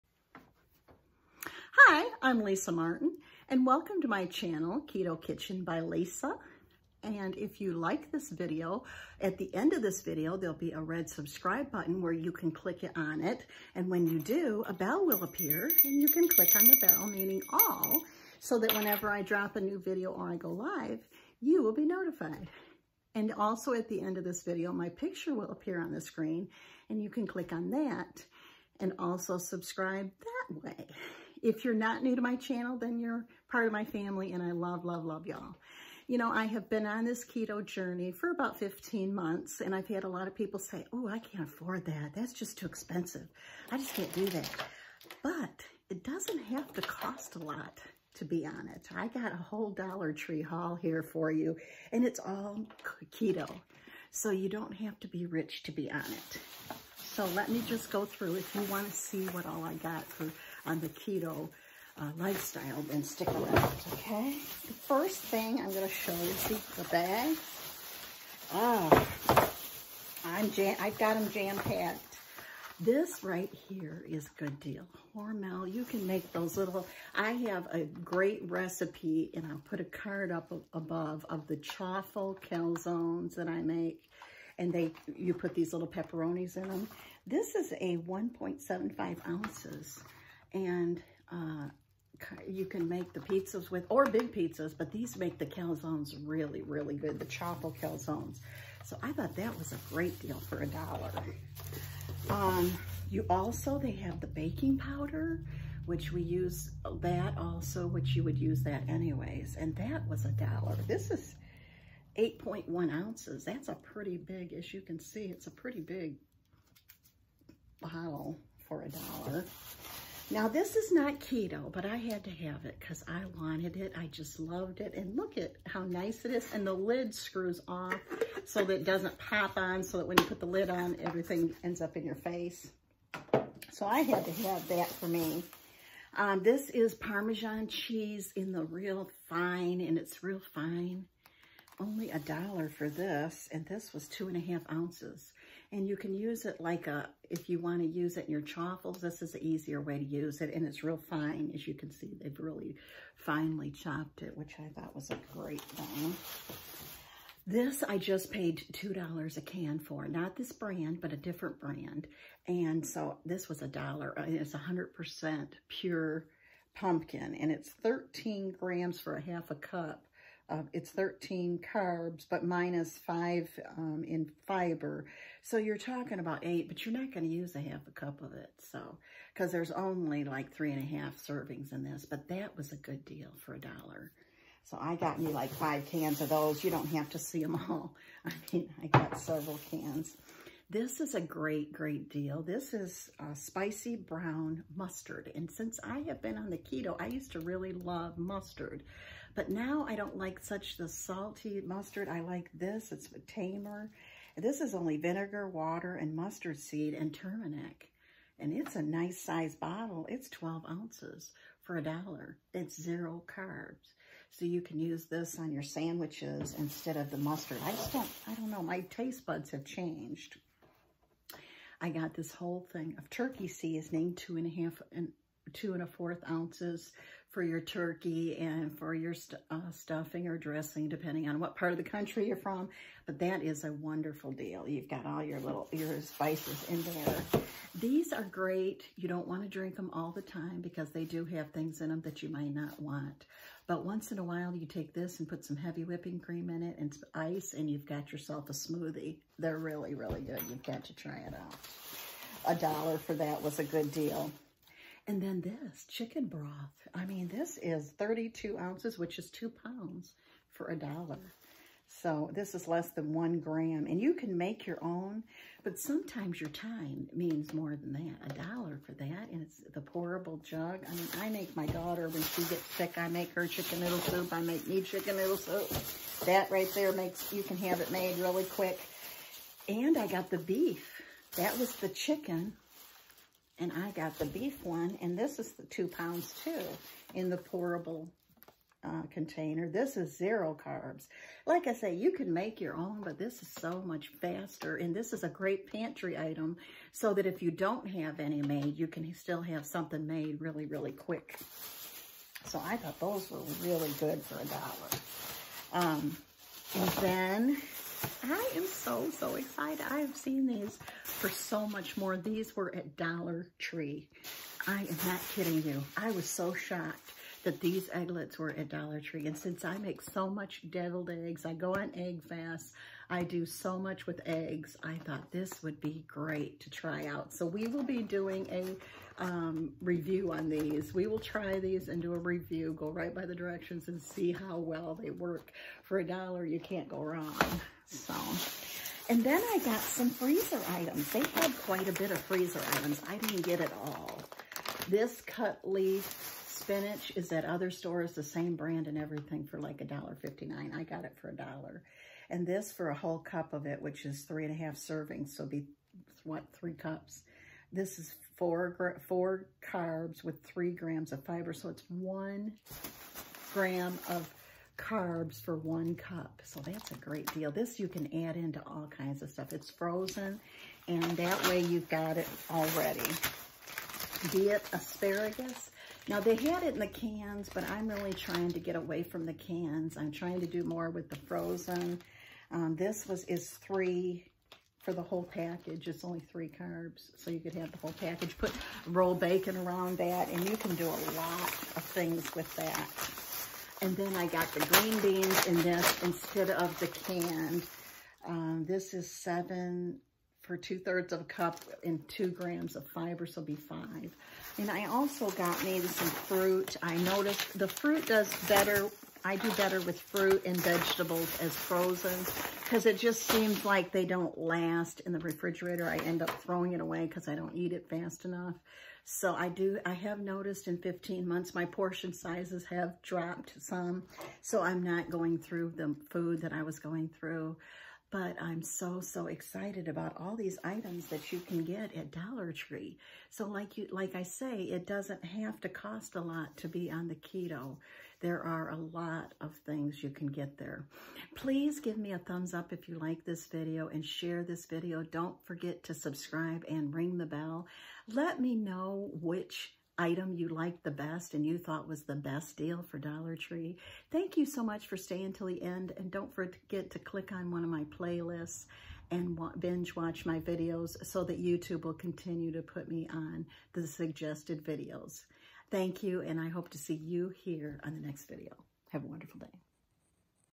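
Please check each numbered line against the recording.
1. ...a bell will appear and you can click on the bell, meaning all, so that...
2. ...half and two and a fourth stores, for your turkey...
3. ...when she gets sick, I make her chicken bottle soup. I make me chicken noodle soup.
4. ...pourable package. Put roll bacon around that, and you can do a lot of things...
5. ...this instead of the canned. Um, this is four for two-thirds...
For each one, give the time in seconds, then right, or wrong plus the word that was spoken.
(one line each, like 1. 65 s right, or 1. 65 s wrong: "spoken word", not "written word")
1. 14 s right
2. 224 s wrong: "ounces", not "stores"
3. 272 s wrong: "noodle", not "bottle"
4. 387 s wrong: "whole", not "pourable"
5. 395 s wrong: "seven", not "four".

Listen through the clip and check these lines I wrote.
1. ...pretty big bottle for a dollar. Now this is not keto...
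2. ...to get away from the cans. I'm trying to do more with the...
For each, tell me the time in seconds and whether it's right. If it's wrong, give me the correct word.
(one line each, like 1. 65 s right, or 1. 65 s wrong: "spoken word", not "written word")
1. 115 s right
2. 378 s right.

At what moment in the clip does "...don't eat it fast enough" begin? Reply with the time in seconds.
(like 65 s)
417 s.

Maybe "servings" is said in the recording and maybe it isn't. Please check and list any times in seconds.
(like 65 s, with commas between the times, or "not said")
181 s, 354 s.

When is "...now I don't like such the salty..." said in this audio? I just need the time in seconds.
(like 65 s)
199 s.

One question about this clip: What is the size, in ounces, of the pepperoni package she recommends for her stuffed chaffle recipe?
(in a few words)
1.75 ounces.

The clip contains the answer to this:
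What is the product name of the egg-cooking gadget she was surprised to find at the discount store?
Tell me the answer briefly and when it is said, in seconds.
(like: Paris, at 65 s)
Egglettes, at 317 s.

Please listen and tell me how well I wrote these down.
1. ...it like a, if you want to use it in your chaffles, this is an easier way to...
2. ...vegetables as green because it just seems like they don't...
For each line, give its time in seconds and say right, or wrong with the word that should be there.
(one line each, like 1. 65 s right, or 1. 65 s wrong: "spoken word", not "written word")
1. 146 s right
2. 410 s wrong: "frozen", not "green".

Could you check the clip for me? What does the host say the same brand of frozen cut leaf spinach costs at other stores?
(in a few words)
$1.59.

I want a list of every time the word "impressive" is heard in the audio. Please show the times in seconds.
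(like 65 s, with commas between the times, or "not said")
not said.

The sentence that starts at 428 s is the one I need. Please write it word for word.
But I'm so, so excited about all these items that you can get at Dollar Tree.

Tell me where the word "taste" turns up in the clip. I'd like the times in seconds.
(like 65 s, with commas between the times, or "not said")
218 s.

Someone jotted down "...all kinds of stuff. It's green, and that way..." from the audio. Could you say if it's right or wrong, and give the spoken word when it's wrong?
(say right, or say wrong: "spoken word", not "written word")
wrong: "frozen", not "green".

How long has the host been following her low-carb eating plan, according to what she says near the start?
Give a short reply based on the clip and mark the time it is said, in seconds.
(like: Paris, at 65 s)
15 months, at 38 s.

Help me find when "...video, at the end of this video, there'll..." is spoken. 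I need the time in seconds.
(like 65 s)
8 s.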